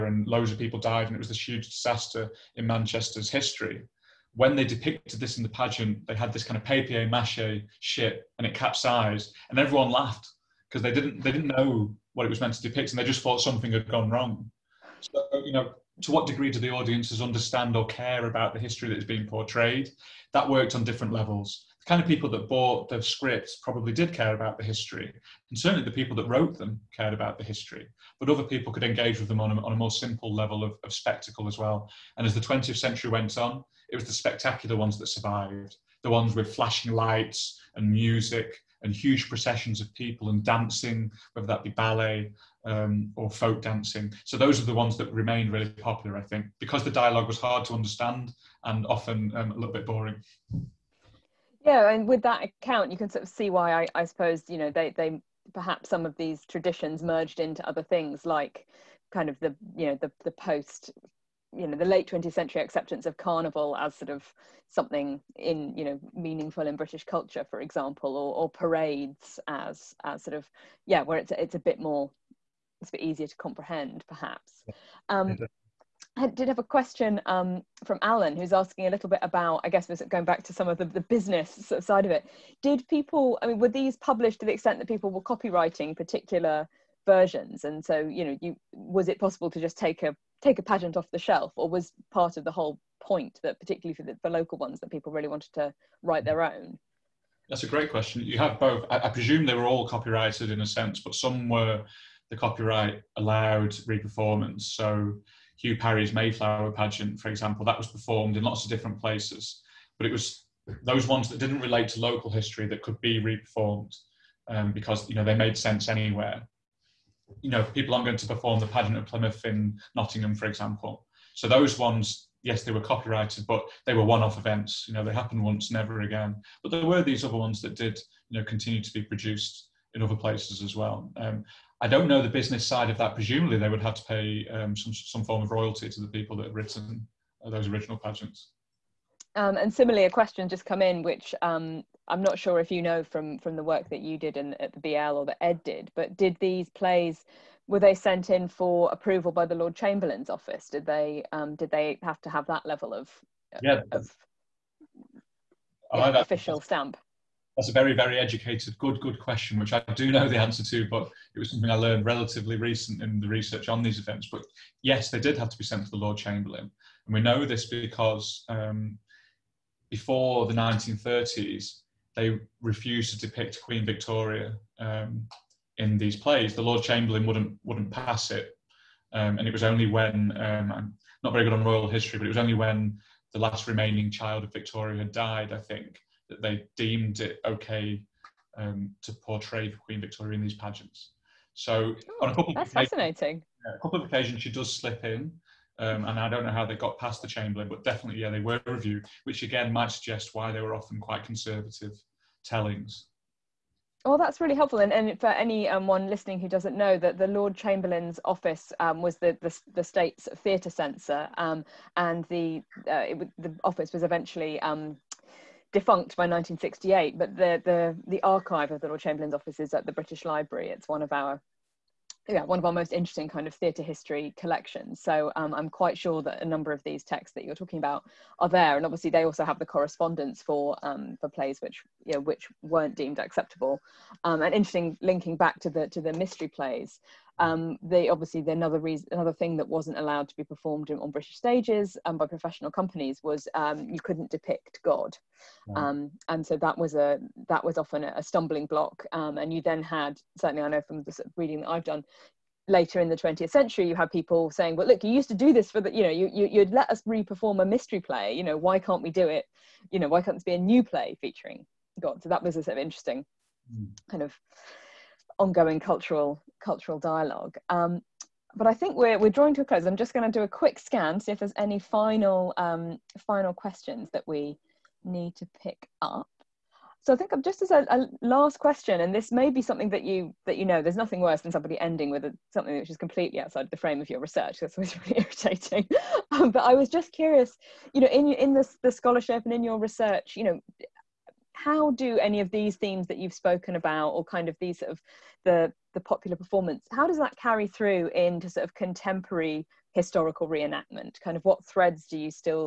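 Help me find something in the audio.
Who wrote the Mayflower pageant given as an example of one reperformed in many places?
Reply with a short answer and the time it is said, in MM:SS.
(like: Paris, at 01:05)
Hugh Parry, at 01:45.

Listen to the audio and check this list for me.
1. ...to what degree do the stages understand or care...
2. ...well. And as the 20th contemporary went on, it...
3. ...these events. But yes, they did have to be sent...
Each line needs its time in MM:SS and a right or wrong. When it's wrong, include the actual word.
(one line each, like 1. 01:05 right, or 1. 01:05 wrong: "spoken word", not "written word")
1. 00:16 wrong: "audiences", not "stages"
2. 00:31 wrong: "century", not "contemporary"
3. 02:43 right.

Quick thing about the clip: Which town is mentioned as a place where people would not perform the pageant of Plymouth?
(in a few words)
Nottingham.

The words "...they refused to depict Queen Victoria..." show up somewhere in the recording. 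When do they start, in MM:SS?
02:52.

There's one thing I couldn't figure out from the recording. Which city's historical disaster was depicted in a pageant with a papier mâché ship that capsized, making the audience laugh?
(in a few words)
Manchester.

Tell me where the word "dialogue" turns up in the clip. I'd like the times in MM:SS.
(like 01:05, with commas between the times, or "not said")
00:46, 04:26.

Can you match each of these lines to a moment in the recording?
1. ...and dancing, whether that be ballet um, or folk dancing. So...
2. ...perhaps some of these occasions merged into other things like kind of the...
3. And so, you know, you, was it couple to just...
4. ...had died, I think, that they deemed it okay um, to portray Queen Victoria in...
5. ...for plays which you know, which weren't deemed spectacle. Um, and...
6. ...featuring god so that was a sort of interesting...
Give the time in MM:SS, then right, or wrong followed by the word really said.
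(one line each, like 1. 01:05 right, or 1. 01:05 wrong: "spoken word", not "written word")
1. 00:40 right
2. 00:55 wrong: "traditions", not "occasions"
3. 01:27 wrong: "possible", not "couple"
4. 03:04 right
5. 03:51 wrong: "acceptable", not "spectacle"
6. 04:21 right.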